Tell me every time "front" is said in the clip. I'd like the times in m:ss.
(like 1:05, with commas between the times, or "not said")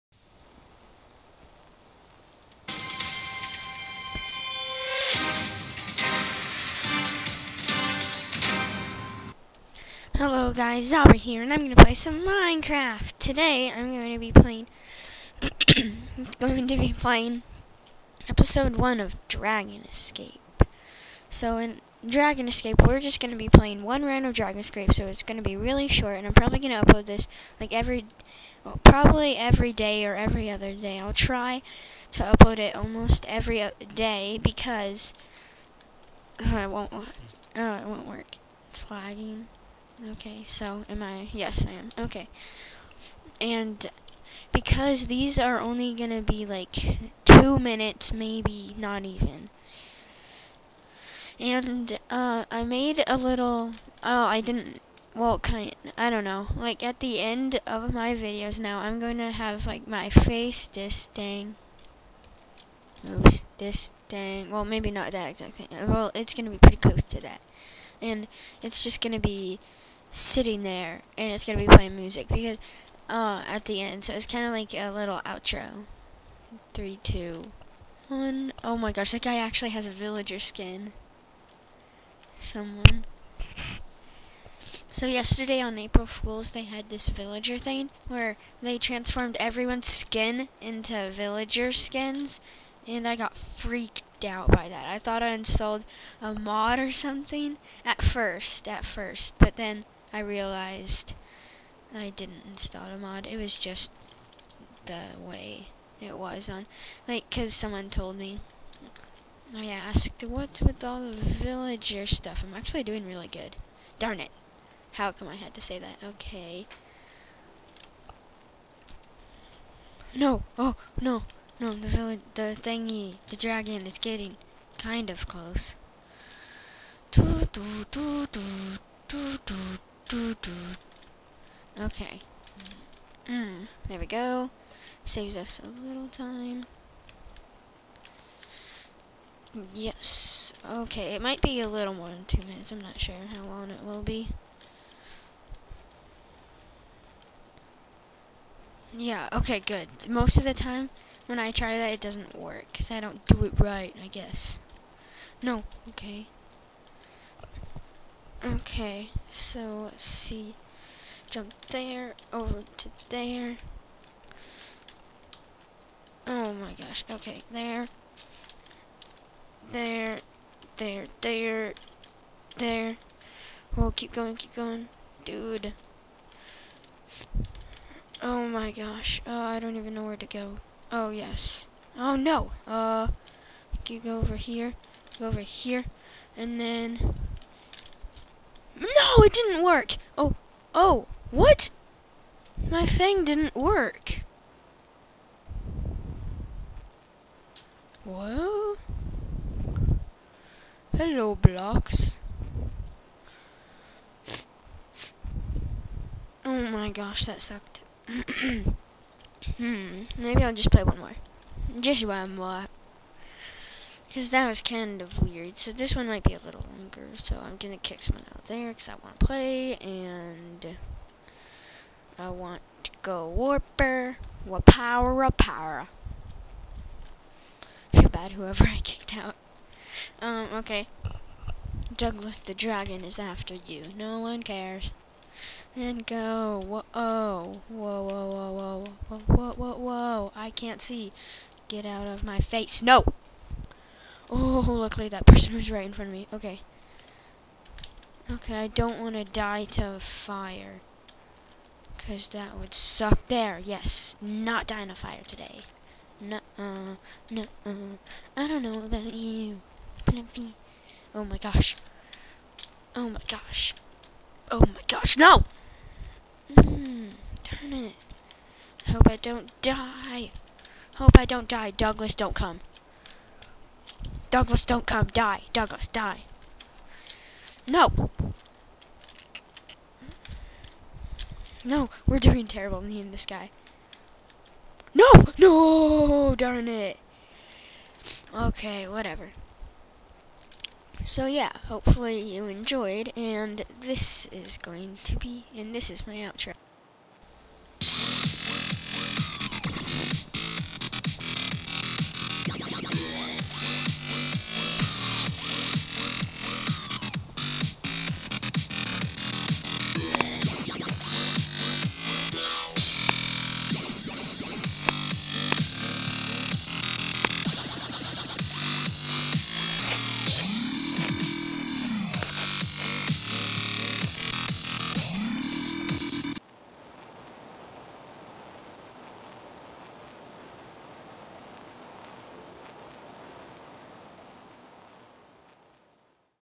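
4:05.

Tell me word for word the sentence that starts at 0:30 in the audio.
I'll try to upload it almost every day, because, uh, it won't, uh, it won't work.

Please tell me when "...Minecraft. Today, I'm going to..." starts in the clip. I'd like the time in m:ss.
0:12.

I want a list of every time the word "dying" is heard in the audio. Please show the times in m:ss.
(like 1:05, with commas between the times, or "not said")
4:14.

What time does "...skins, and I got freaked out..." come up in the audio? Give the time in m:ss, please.
1:31.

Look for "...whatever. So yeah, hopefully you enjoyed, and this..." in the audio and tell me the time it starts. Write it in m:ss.
4:48.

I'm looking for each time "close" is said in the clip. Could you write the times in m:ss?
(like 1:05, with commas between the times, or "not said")
1:06, 2:05.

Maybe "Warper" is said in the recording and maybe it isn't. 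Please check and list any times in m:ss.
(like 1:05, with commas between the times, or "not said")
3:43.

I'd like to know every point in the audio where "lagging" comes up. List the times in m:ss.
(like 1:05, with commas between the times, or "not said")
0:38.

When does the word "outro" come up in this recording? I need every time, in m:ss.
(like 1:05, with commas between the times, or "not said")
1:15, 4:56.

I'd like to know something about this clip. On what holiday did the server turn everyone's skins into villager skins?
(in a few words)
April Fools.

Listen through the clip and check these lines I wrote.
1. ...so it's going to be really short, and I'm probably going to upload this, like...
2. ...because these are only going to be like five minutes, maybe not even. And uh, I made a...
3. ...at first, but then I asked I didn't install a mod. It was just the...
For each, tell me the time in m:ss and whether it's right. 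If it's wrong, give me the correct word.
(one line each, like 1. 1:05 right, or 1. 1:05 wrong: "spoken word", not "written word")
1. 0:24 right
2. 0:44 wrong: "two", not "five"
3. 1:38 wrong: "realized", not "asked".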